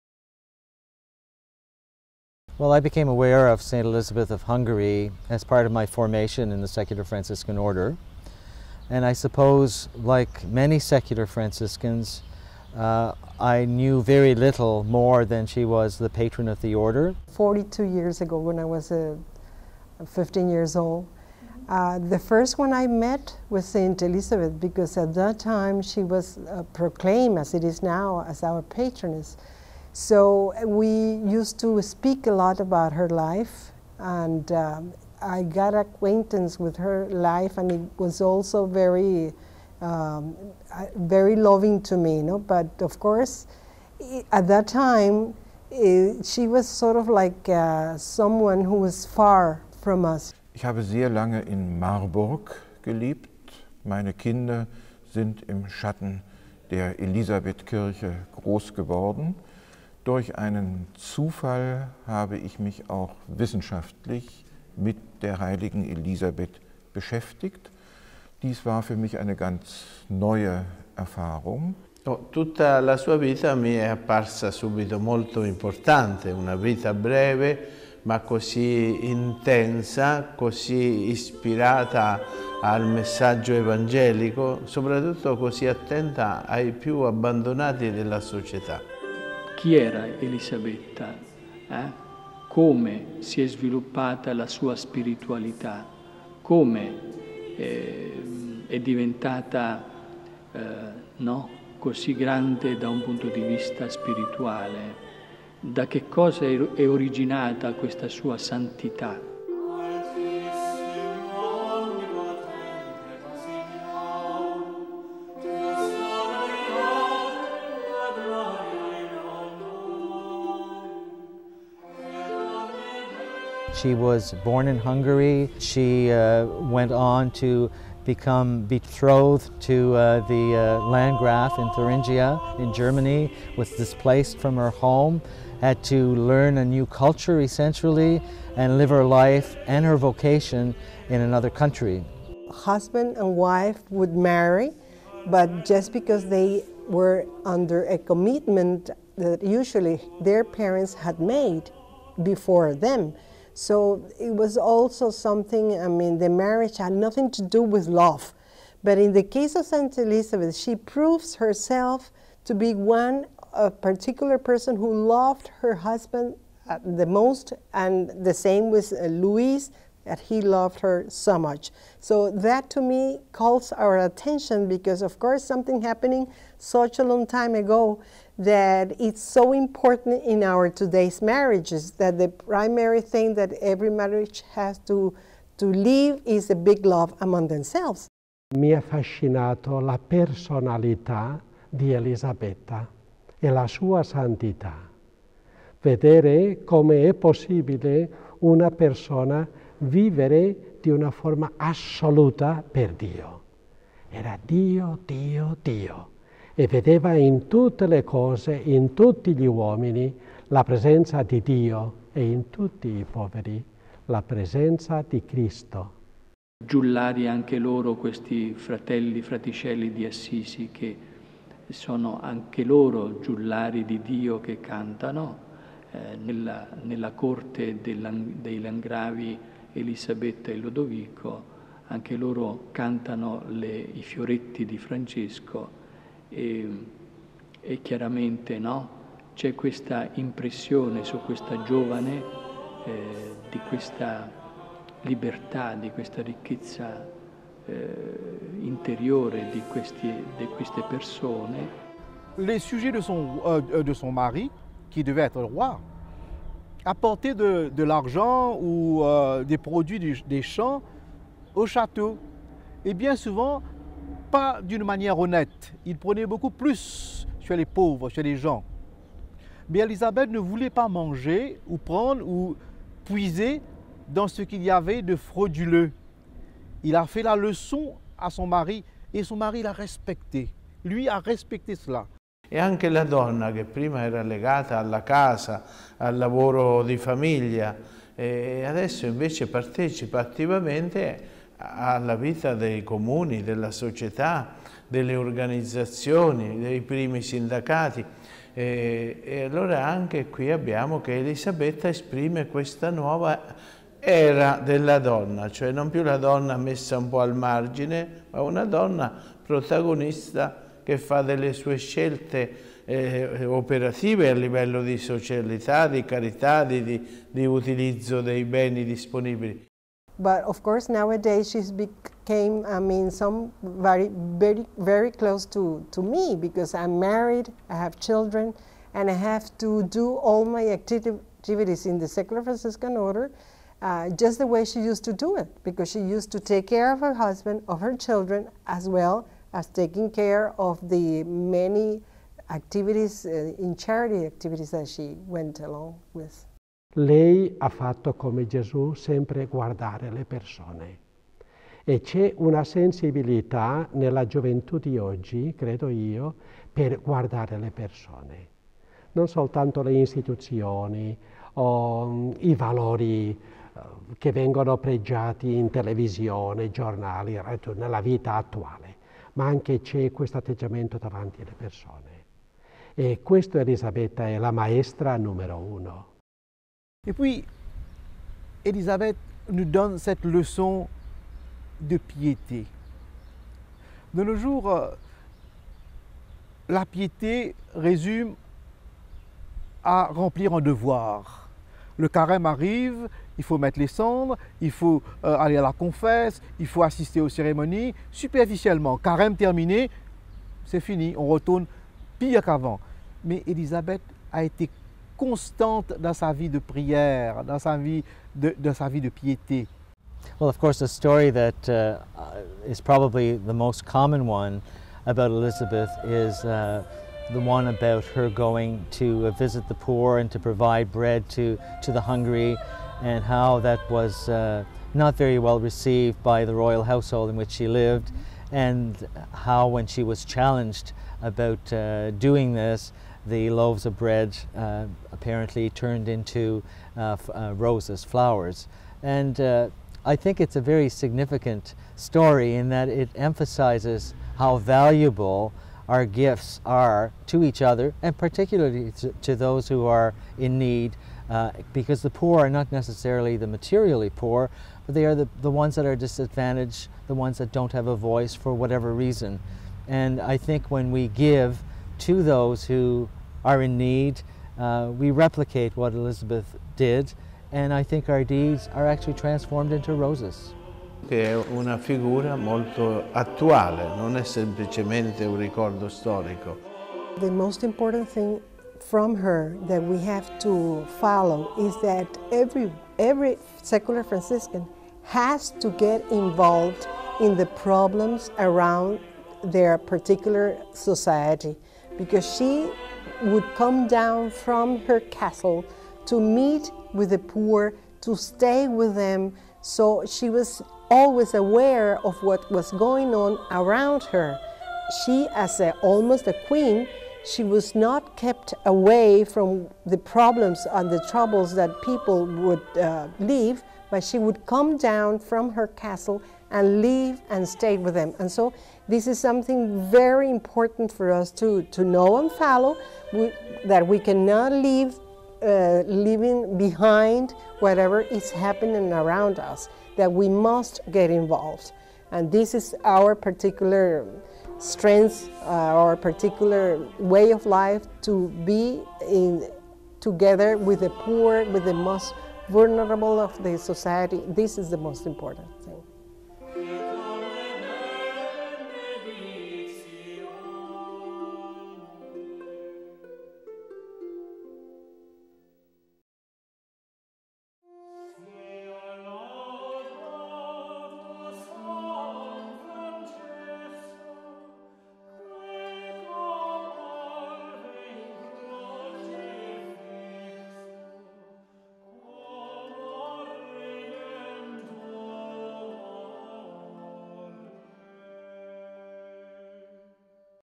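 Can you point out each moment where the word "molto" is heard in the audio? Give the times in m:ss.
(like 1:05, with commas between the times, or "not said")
1:14, 7:52.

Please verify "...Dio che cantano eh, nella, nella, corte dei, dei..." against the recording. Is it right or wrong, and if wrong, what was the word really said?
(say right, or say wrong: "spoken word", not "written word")
right.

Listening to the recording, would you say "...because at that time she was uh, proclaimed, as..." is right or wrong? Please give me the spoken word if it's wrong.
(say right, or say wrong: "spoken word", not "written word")
right.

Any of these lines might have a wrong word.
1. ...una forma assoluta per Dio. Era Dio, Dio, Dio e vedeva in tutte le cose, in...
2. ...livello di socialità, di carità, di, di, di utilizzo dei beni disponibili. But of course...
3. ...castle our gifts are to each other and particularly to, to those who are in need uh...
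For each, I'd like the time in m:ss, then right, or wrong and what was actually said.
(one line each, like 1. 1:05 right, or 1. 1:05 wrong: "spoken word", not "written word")
1. 3:20 right
2. 5:14 right
3. 7:24 wrong: "valuable", not "castle".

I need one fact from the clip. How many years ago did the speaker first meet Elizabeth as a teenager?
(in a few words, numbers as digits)
42.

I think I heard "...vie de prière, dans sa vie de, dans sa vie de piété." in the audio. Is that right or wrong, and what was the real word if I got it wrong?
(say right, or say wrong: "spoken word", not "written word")
right.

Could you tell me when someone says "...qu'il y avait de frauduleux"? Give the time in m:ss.
4:34.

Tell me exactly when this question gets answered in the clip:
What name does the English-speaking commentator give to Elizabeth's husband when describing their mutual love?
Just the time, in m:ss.
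2:49.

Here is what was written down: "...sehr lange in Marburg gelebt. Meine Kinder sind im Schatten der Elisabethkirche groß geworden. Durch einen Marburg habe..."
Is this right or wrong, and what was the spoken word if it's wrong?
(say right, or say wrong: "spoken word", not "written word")
wrong: "Zufall", not "Marburg".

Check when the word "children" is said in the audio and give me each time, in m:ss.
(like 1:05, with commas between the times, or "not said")
5:28, 5:37.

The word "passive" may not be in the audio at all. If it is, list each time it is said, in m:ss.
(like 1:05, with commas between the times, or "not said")
not said.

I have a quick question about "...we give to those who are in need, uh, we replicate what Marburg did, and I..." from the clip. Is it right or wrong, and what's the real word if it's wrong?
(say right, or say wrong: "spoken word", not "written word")
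wrong: "Elizabeth", not "Marburg".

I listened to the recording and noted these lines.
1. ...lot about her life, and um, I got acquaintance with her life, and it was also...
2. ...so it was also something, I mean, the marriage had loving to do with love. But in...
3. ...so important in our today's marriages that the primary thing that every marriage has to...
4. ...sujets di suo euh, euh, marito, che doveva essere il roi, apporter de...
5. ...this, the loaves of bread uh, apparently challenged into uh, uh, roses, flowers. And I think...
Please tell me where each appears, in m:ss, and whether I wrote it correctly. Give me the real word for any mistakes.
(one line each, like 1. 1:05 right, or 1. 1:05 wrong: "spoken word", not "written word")
1. 0:32 right
2. 2:33 wrong: "nothing", not "loving"
3. 2:59 right
4. 4:12 right
5. 7:12 wrong: "turned", not "challenged".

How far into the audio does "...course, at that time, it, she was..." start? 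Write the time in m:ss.
0:43.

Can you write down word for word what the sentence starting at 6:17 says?
Et puis, Elisabeth nous donne cette leçon de piété.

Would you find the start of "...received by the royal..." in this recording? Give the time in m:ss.
7:05.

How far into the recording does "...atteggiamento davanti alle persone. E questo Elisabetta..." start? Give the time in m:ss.
6:10.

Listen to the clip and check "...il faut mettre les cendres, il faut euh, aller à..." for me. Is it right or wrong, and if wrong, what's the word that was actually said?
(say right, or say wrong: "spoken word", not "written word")
right.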